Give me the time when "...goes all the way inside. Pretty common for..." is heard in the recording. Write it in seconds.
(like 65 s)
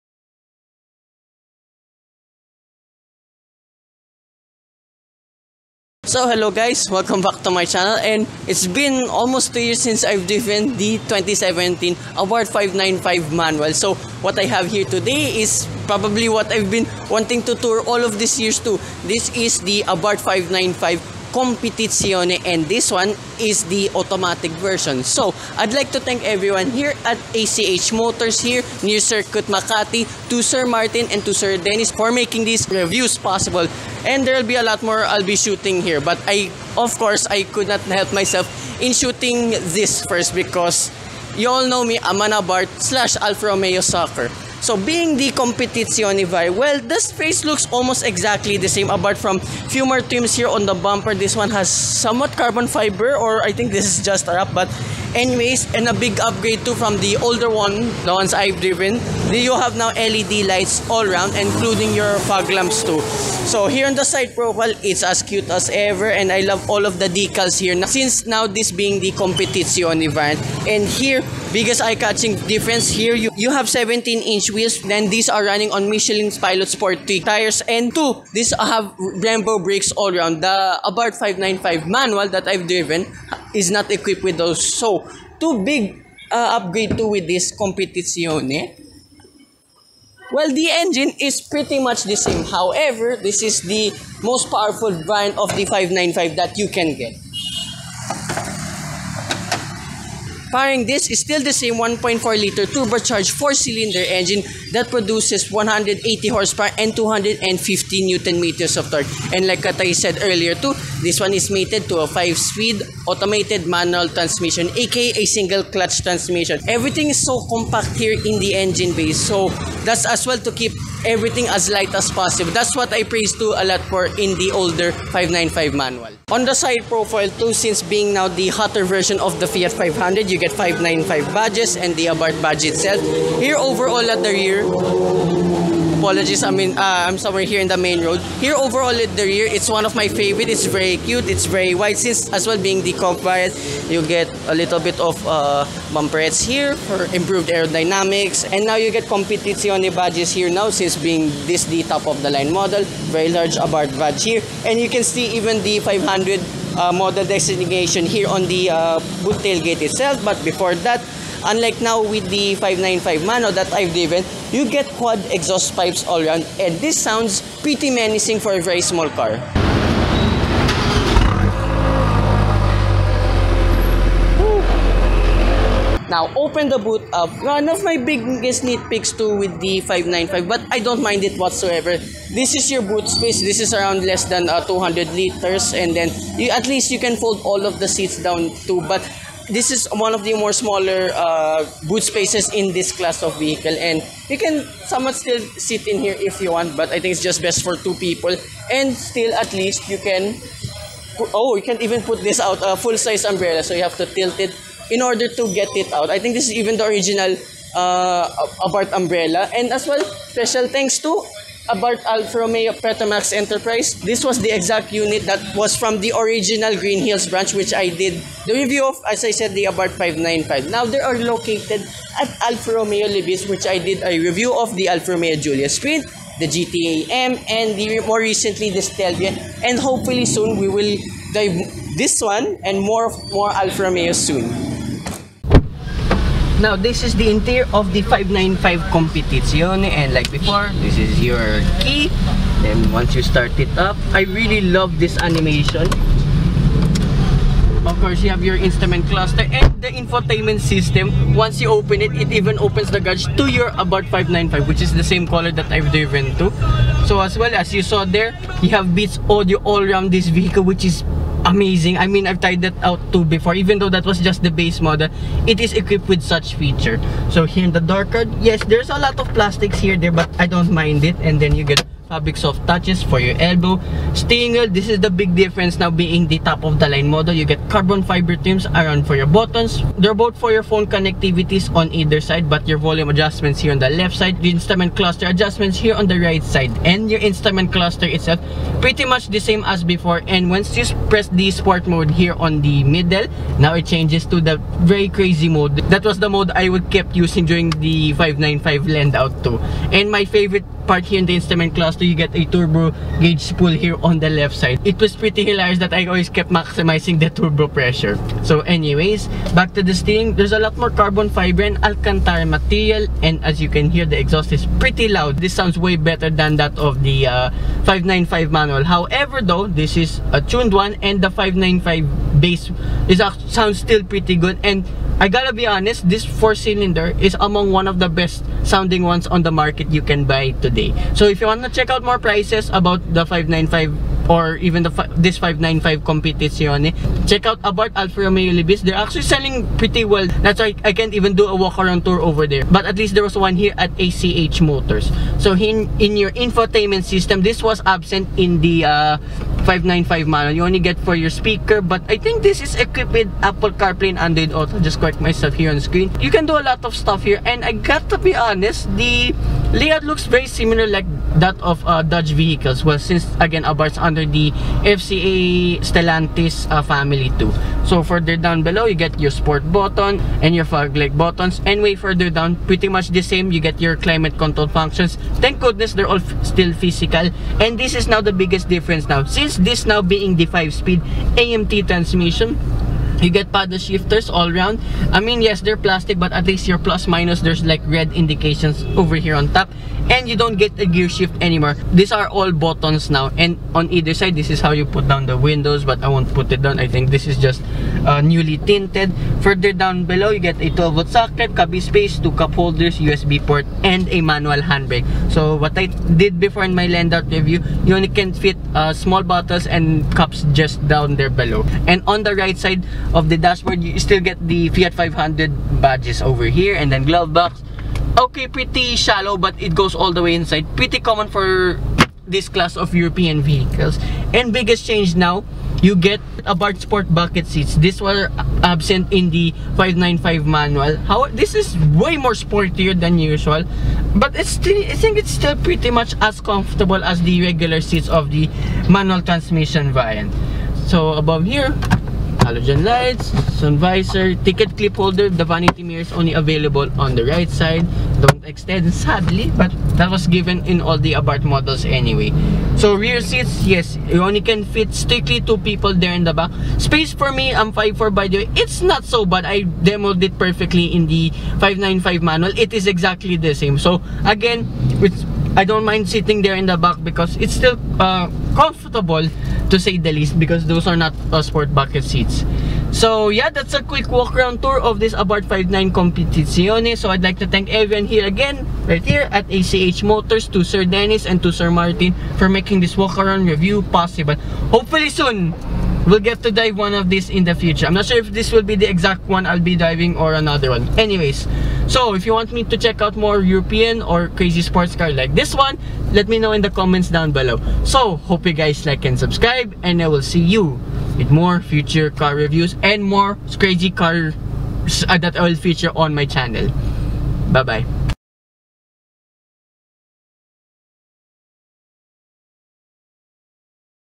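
419 s.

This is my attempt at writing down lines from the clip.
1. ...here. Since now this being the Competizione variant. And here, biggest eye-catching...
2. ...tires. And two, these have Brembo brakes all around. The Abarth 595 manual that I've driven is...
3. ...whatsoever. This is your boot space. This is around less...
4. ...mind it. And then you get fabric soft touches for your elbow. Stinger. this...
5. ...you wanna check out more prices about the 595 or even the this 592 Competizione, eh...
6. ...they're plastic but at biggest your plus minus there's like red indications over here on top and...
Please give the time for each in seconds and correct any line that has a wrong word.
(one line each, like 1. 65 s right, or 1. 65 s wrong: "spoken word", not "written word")
1. 67 s right
2. 77 s right
3. 181 s right
4. 270 s right
5. 331 s wrong: "595", not "592"
6. 385 s wrong: "least", not "biggest".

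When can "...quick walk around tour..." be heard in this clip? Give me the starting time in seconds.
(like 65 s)
473 s.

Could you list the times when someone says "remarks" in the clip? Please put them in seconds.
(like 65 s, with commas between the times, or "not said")
not said.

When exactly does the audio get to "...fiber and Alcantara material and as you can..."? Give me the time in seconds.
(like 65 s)
311 s.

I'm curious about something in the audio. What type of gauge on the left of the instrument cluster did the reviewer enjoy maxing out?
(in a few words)
turbo gauge.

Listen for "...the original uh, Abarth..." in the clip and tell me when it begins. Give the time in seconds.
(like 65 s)
206 s.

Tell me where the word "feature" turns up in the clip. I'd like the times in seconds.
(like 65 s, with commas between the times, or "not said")
266 s, 505 s.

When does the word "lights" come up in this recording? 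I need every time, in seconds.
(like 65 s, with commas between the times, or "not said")
60 s, 121 s, 370 s, 442 s.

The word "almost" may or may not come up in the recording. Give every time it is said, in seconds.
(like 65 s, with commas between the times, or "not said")
9 s, 47 s.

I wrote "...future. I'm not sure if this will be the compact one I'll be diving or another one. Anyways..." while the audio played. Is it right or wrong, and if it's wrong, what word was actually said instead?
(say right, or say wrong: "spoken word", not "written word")
wrong: "exact", not "compact".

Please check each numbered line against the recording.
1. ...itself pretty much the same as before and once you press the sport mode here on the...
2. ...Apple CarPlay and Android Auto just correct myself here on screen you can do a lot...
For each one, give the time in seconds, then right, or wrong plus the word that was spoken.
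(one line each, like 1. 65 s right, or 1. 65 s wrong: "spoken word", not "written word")
1. 288 s right
2. 353 s right.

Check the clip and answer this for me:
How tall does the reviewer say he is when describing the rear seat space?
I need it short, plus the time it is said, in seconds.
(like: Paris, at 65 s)
5'4, at 457 s.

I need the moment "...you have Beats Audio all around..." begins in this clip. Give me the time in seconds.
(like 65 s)
258 s.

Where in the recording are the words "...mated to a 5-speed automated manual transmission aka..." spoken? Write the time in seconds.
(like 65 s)
111 s.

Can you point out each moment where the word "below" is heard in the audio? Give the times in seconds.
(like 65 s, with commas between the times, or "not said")
368 s, 400 s, 411 s, 497 s.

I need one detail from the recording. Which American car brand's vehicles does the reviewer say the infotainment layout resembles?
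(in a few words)
Dodge.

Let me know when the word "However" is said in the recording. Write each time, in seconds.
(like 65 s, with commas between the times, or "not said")
92 s, 318 s.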